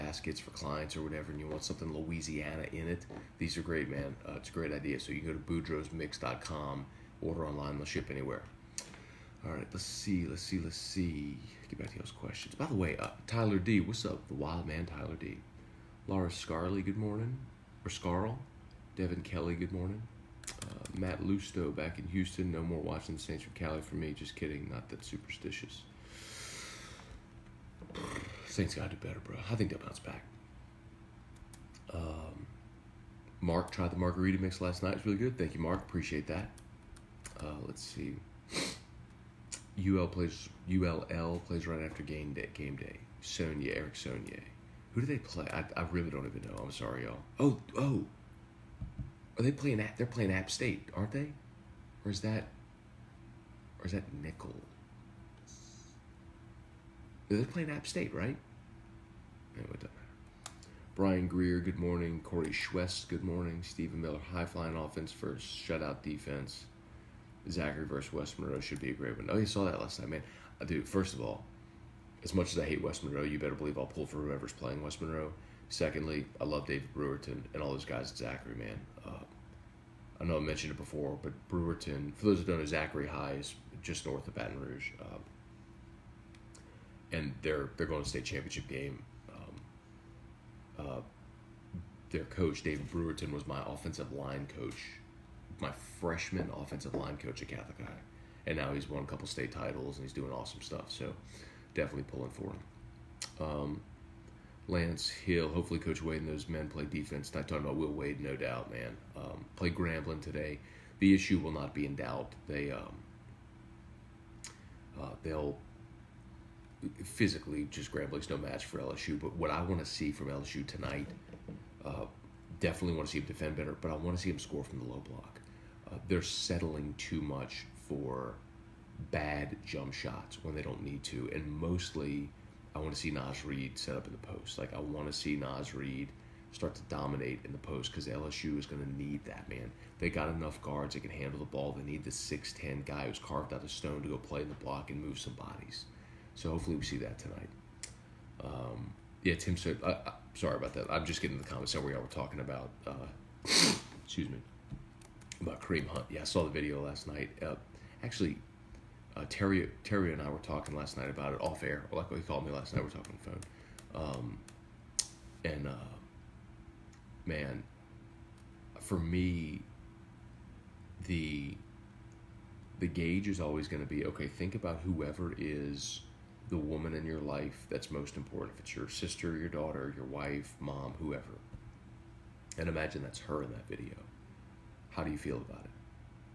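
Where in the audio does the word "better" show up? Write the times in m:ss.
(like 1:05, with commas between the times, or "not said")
0:29, 1:13, 2:03.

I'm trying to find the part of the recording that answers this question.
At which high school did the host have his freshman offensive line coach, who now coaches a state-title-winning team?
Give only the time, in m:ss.
1:37.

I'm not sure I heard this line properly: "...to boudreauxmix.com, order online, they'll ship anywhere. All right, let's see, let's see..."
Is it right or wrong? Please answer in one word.
right.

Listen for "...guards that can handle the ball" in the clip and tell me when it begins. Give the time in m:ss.
2:20.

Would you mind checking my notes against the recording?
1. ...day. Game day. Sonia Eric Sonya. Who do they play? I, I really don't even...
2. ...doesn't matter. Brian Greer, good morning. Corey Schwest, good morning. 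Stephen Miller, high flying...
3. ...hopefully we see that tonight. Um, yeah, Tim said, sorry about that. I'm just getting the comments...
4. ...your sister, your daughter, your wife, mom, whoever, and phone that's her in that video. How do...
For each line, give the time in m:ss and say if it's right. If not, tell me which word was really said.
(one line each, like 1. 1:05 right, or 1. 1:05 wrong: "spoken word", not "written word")
1. 0:42 right
2. 0:59 right
3. 2:26 right
4. 2:58 wrong: "imagine", not "phone".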